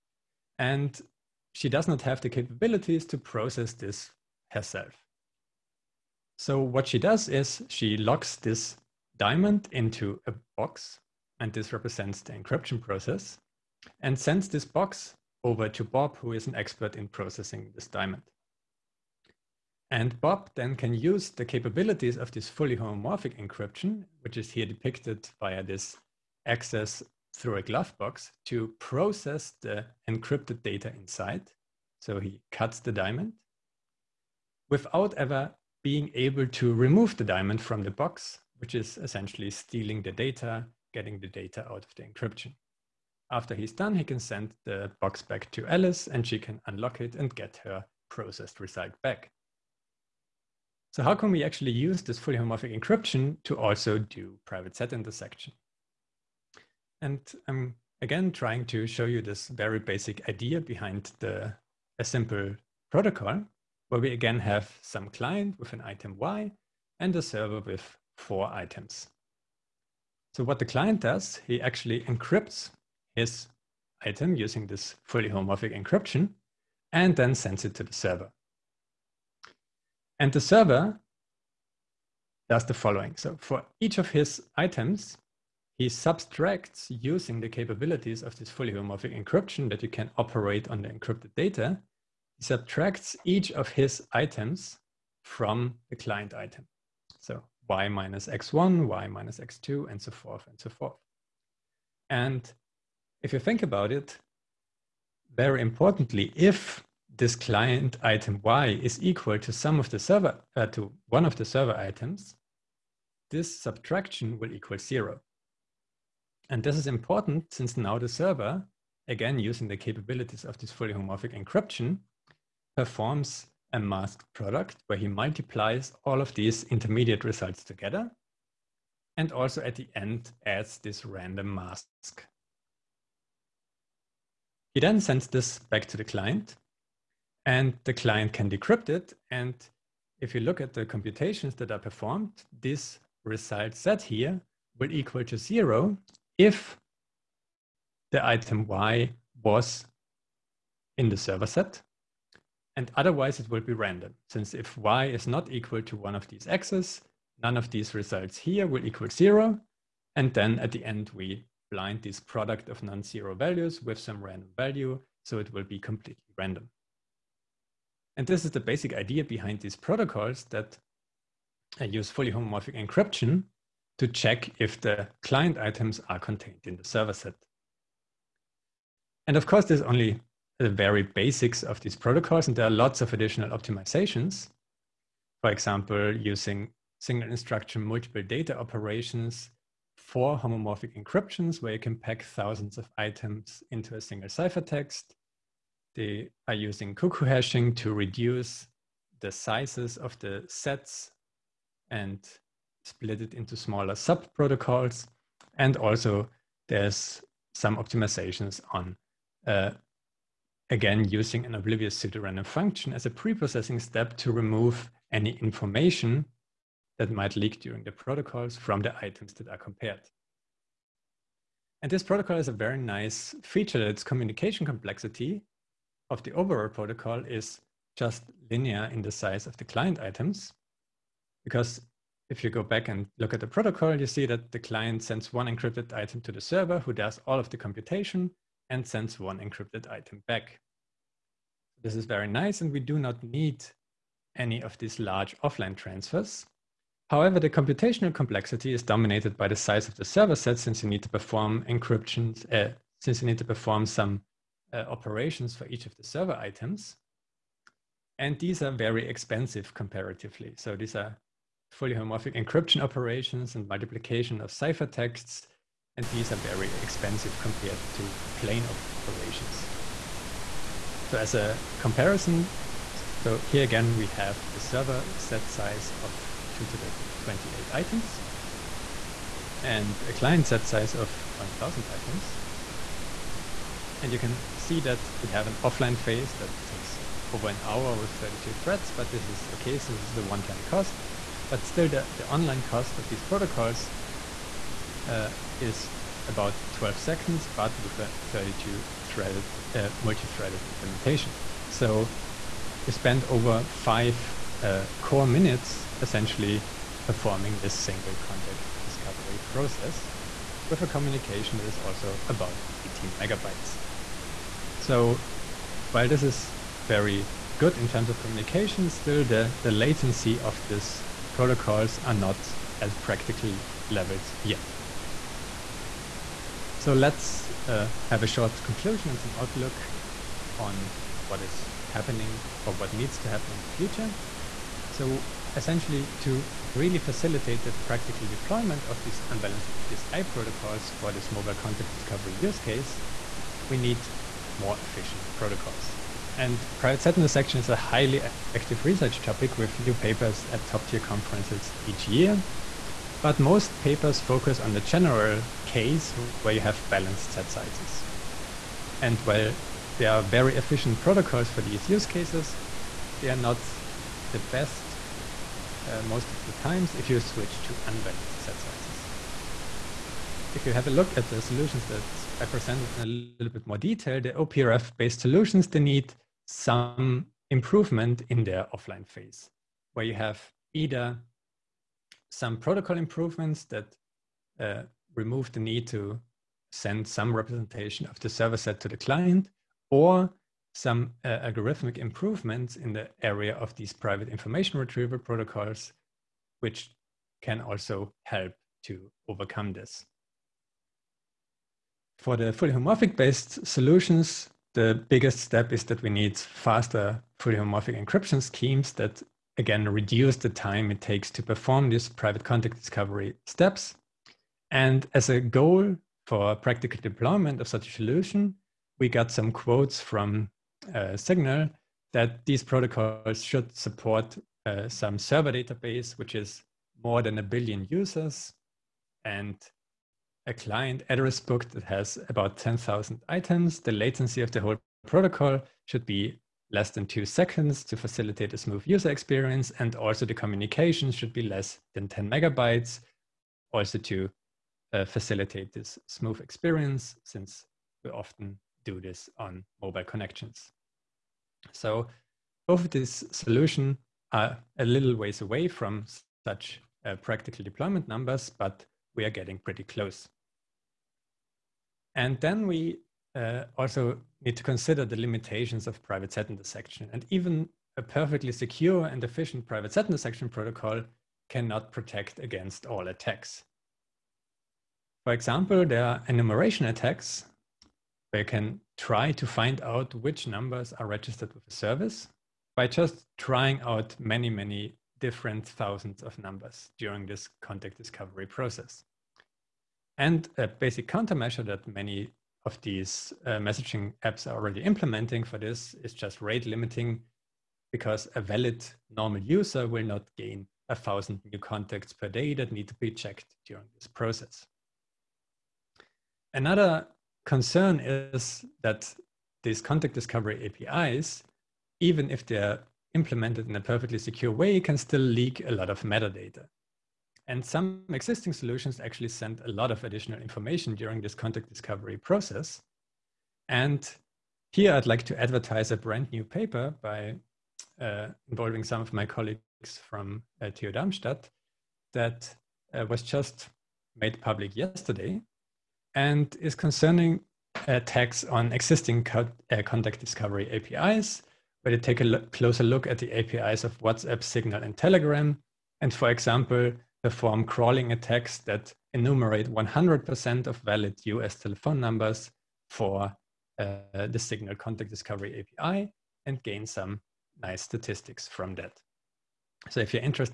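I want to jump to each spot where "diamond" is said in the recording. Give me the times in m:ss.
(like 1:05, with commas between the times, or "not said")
0:09, 0:17, 0:32, 0:37.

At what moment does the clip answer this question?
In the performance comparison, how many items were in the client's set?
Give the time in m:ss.
4:41.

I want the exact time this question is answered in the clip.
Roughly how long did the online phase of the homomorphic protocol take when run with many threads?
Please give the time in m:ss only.
4:56.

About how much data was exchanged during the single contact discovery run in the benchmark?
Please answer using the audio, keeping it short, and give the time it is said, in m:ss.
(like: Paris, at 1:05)
18 megabytes, at 5:12.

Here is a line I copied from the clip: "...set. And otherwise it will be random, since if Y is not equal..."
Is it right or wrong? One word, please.
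right.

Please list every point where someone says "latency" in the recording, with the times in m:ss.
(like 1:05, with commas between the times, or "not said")
5:19, 7:13.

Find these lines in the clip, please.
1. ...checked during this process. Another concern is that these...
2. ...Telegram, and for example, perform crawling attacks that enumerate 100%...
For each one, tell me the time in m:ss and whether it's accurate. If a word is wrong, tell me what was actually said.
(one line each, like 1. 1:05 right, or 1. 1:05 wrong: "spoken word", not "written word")
1. 8:23 right
2. 9:04 right.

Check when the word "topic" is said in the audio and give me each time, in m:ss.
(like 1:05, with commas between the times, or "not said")
5:49.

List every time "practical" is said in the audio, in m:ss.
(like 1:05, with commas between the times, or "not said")
5:23, 5:37, 6:56, 7:37.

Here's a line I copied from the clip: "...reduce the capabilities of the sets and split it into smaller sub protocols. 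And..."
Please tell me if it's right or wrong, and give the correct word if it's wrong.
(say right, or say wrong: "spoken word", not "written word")
wrong: "sizes", not "capabilities".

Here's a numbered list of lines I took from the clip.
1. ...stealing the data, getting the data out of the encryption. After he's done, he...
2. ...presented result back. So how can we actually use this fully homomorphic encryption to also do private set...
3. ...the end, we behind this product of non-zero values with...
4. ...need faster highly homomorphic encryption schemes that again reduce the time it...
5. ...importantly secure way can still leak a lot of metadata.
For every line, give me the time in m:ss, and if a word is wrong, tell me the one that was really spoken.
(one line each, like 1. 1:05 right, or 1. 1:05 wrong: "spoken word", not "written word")
1. 0:39 right
2. 0:48 wrong: "processed", not "presented"
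3. 2:40 wrong: "blind", not "behind"
4. 6:46 wrong: "fully", not "highly"
5. 8:33 wrong: "perfectly", not "importantly".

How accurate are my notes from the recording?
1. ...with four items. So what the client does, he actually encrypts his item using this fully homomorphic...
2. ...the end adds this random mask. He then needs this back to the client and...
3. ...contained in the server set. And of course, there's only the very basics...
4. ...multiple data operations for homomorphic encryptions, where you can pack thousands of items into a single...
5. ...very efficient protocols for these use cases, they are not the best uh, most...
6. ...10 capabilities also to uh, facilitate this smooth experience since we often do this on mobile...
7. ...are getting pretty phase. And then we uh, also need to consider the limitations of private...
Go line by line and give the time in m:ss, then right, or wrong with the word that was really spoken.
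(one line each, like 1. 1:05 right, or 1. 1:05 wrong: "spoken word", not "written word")
1. 1:07 right
2. 2:09 wrong: "sends", not "needs"
3. 2:56 right
4. 3:07 right
5. 6:00 right
6. 7:22 wrong: "megabytes", not "capabilities"
7. 7:39 wrong: "close", not "phase".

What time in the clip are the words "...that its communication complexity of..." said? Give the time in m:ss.
3:43.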